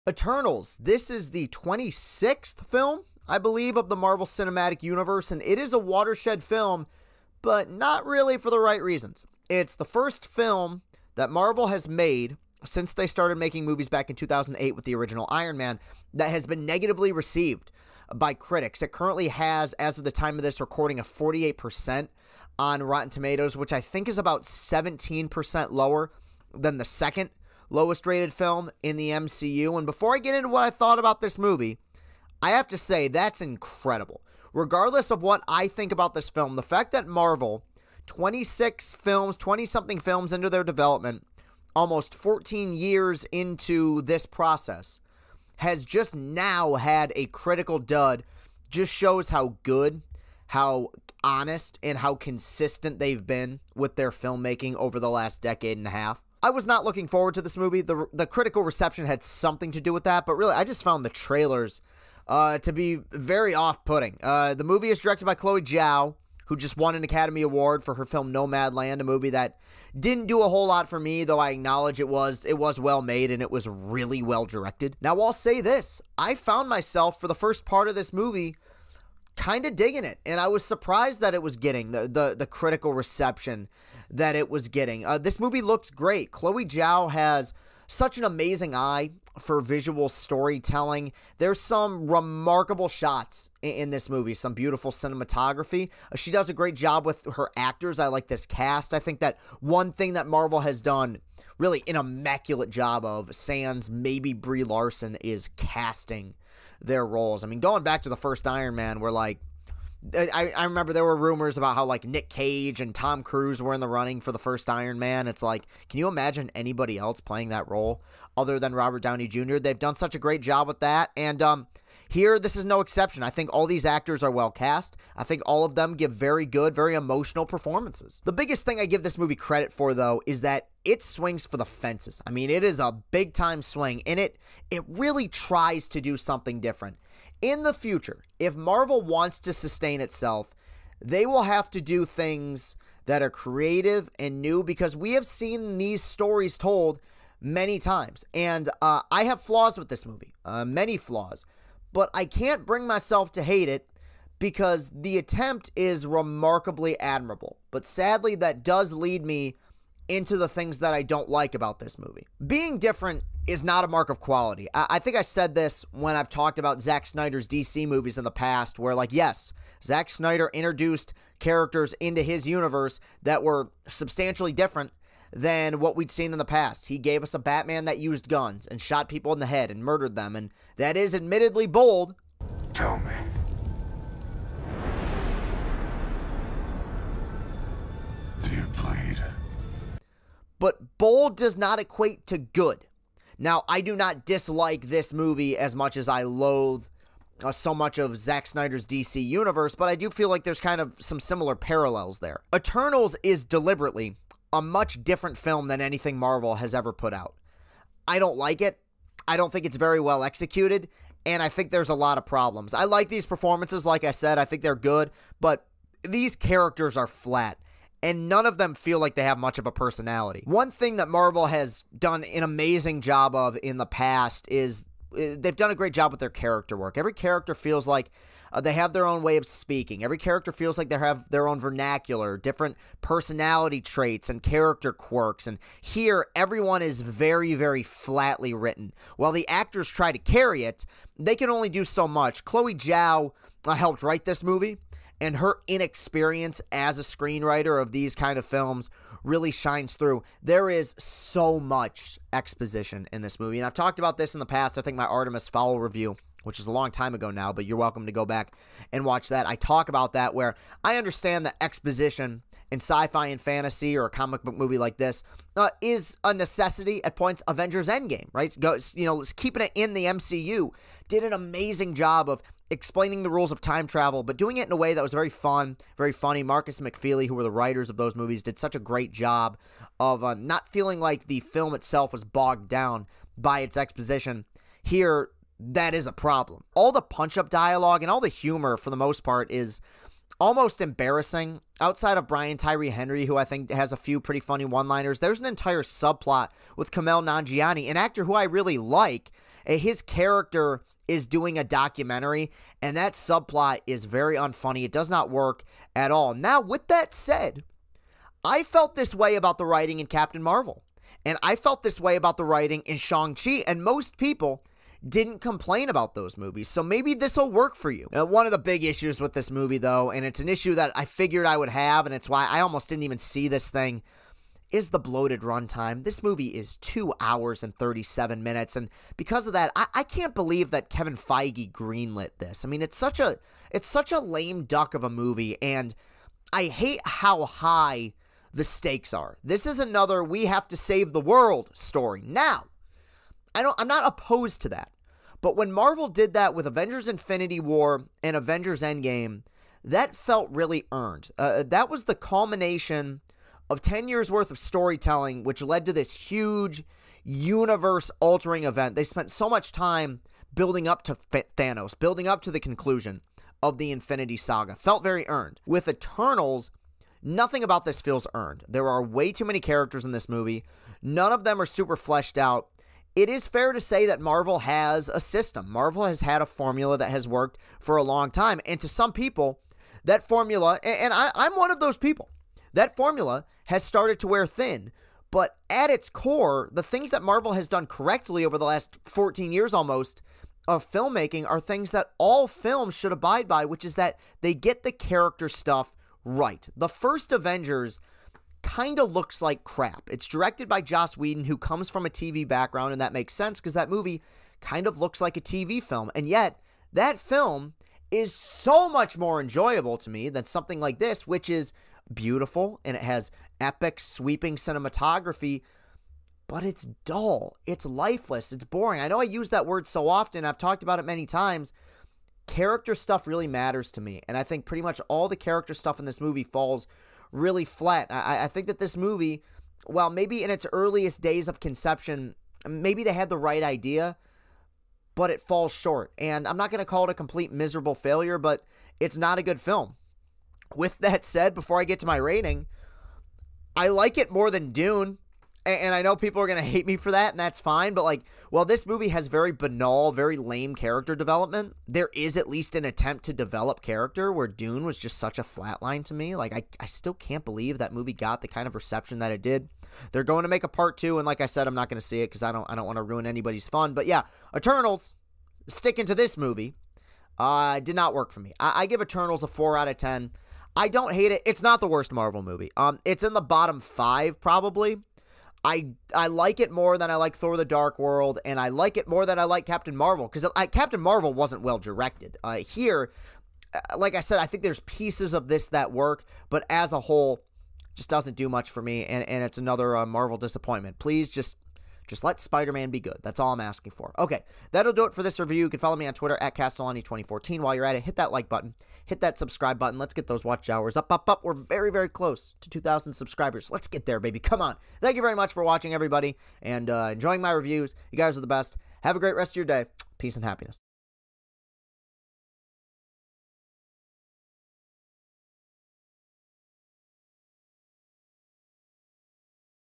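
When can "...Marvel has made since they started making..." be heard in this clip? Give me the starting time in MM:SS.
00:11.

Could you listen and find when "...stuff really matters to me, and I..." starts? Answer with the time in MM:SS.
07:02.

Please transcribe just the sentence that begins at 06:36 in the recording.
The first Avengers kind of looks like crap.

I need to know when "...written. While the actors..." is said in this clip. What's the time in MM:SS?
03:58.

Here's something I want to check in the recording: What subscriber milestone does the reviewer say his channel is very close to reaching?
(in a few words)
2,000.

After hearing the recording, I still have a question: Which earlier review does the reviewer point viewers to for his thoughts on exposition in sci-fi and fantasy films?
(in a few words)
Artemis Fowl.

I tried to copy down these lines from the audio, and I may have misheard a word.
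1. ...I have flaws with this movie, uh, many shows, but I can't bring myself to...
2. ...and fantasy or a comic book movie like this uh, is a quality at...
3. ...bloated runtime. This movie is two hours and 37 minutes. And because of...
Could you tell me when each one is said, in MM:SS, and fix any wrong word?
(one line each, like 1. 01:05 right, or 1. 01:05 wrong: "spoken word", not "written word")
1. 02:29 wrong: "flaws", not "shows"
2. 04:23 wrong: "necessity", not "quality"
3. 05:24 right.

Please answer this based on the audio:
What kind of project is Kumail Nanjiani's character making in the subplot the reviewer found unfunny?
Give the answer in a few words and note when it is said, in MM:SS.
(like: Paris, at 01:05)
a documentary, at 05:01.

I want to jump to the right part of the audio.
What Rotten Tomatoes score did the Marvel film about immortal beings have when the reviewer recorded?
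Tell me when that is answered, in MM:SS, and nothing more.
00:21.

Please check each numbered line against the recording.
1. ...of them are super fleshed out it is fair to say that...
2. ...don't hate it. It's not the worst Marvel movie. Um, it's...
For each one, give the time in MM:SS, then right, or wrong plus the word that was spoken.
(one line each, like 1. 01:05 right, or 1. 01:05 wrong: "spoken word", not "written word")
1. 06:11 right
2. 07:50 right.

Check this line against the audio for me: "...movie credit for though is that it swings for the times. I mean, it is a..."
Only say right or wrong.
wrong.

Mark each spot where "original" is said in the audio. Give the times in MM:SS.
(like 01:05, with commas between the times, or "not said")
00:14.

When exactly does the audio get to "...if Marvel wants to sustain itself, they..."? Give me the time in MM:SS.
02:18.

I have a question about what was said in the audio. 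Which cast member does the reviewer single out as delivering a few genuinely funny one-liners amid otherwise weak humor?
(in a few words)
Brian Tyree Henry.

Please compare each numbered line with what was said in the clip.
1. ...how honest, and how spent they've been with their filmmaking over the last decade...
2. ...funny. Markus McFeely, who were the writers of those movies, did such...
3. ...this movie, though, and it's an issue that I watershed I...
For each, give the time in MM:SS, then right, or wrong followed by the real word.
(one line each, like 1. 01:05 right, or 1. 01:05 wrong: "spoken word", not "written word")
1. 00:50 wrong: "consistent", not "spent"
2. 04:36 right
3. 05:19 wrong: "figured", not "watershed".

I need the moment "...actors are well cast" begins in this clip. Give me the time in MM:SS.
02:03.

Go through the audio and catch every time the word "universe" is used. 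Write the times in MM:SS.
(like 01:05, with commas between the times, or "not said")
00:04, 02:52, 03:19, 05:57.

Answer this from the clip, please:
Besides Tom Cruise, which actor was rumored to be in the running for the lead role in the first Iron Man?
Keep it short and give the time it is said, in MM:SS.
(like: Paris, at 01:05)
Nick Cage, at 01:52.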